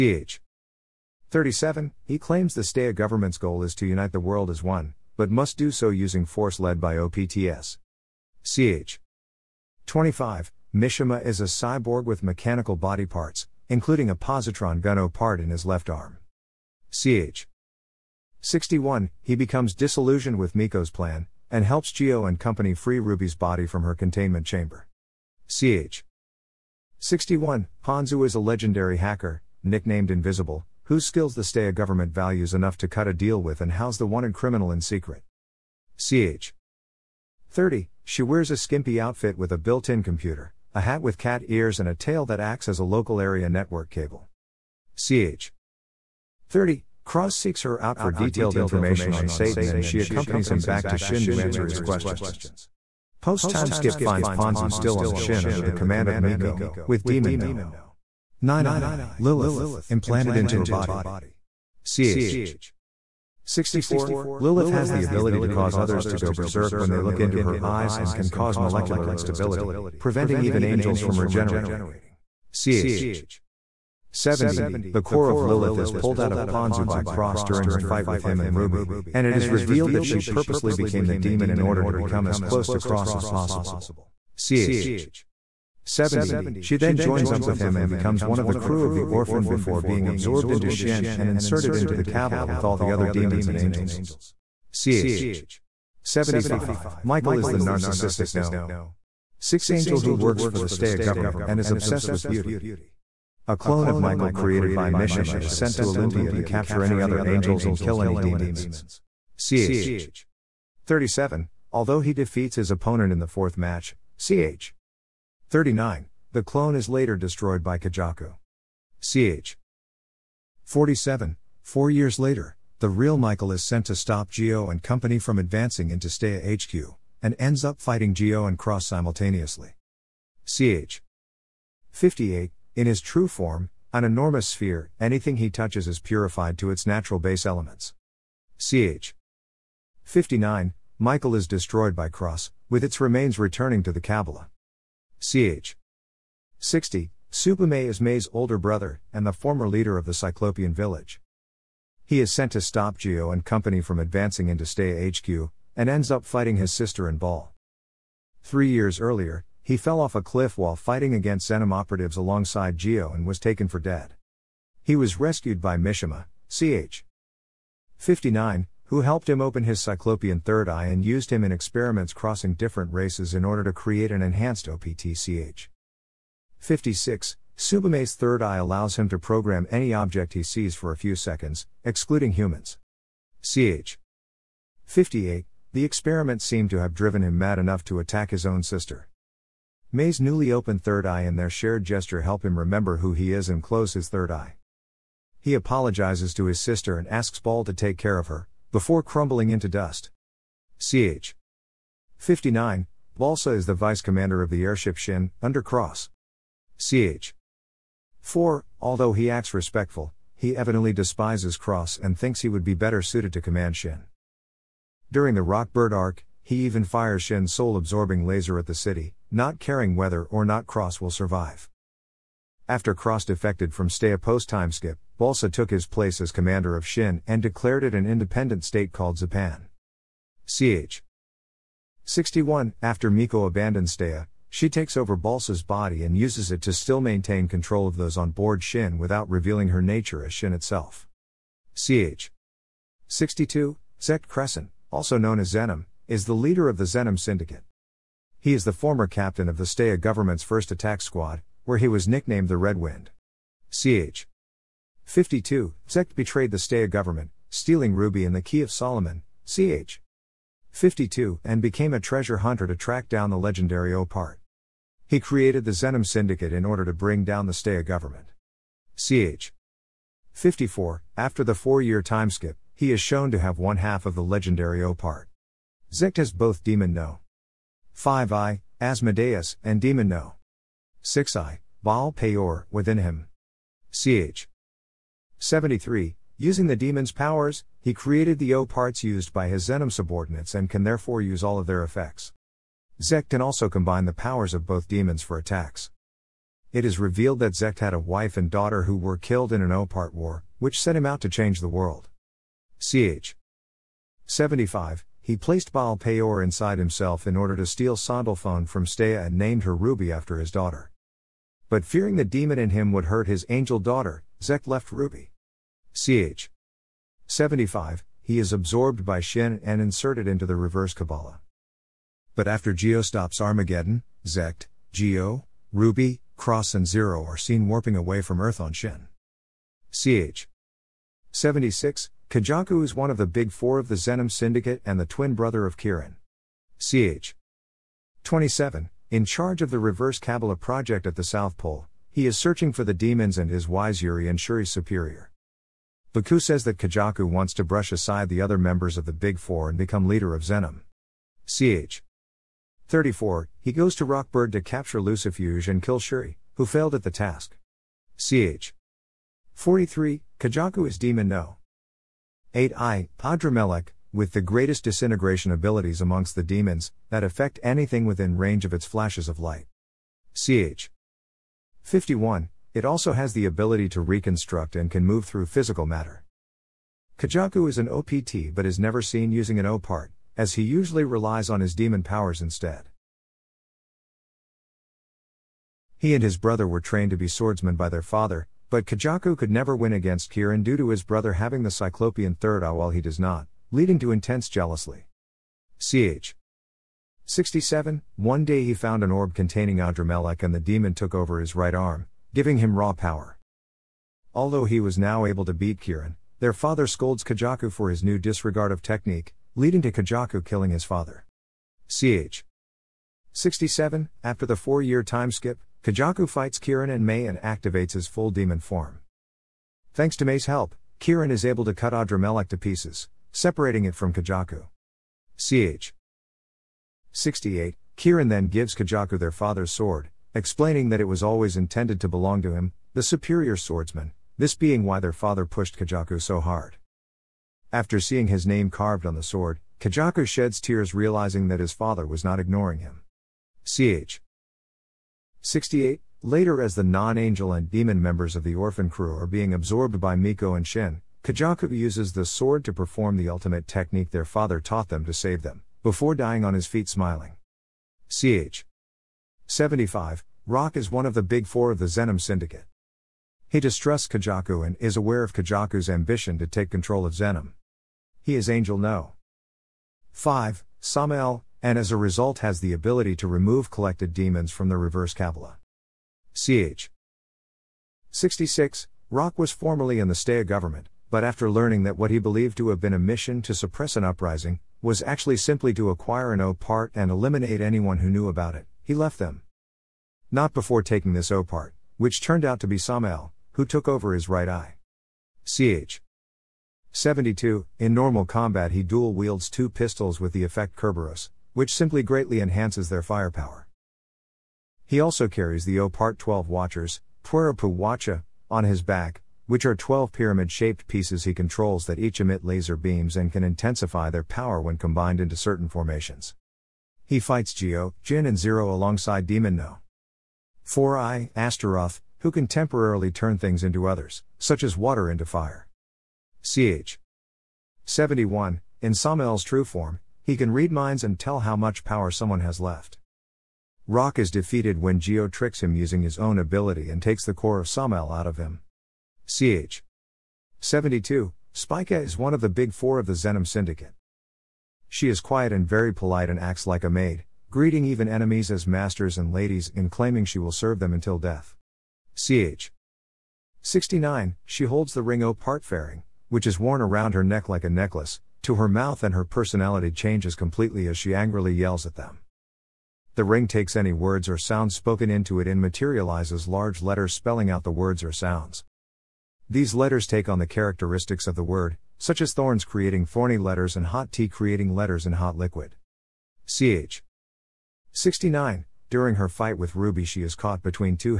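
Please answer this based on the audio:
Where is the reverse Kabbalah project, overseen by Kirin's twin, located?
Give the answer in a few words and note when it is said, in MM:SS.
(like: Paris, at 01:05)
South Pole, at 05:41.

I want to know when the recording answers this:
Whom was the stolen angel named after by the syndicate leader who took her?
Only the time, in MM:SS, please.
05:10.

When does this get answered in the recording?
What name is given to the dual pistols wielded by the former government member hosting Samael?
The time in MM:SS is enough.
08:20.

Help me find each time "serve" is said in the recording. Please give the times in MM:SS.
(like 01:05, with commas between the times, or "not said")
09:10.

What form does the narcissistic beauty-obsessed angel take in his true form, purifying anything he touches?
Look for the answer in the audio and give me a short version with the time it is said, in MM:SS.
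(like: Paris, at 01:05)
An enormous sphere, at 02:13.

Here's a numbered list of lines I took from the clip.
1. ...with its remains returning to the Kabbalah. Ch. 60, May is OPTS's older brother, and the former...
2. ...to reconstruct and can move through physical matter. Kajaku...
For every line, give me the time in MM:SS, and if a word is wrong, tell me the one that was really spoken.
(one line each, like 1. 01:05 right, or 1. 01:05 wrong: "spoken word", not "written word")
1. 02:22 wrong: "May", not "OPTS"
2. 06:13 right.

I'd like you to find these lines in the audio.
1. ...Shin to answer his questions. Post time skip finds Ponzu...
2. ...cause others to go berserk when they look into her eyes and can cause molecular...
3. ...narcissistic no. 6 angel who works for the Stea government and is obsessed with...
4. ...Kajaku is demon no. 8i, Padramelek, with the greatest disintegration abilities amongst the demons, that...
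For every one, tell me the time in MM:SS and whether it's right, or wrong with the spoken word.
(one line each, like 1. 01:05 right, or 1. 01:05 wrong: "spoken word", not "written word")
1. 00:50 right
2. 01:05 right
3. 01:37 right
4. 06:00 right.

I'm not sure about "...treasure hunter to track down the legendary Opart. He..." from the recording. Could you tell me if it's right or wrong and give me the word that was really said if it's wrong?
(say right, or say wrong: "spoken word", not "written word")
right.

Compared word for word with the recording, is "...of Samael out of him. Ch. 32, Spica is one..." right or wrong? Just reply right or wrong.
wrong.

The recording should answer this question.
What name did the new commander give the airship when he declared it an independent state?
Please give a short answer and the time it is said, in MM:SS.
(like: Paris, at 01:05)
Zapan, at 03:49.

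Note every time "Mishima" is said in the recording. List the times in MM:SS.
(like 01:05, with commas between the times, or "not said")
00:10, 01:44, 02:45.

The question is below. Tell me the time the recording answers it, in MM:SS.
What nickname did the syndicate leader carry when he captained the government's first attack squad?
04:12.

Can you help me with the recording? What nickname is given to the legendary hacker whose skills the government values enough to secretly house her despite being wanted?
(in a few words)
Invisible.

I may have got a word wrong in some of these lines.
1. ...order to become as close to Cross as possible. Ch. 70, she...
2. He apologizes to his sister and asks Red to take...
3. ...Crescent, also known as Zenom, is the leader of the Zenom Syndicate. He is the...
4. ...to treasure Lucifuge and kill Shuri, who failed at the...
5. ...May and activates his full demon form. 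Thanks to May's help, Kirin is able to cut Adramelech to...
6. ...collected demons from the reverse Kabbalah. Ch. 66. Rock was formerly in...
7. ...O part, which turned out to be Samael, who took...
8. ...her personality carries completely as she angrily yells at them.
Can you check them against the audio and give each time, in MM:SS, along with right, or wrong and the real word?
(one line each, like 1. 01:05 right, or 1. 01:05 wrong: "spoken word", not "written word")
1. 01:21 right
2. 03:15 wrong: "Ball", not "Red"
3. 04:04 right
4. 05:54 wrong: "capture", not "treasure"
5. 06:57 right
6. 07:53 right
7. 08:11 right
8. 09:19 wrong: "changes", not "carries".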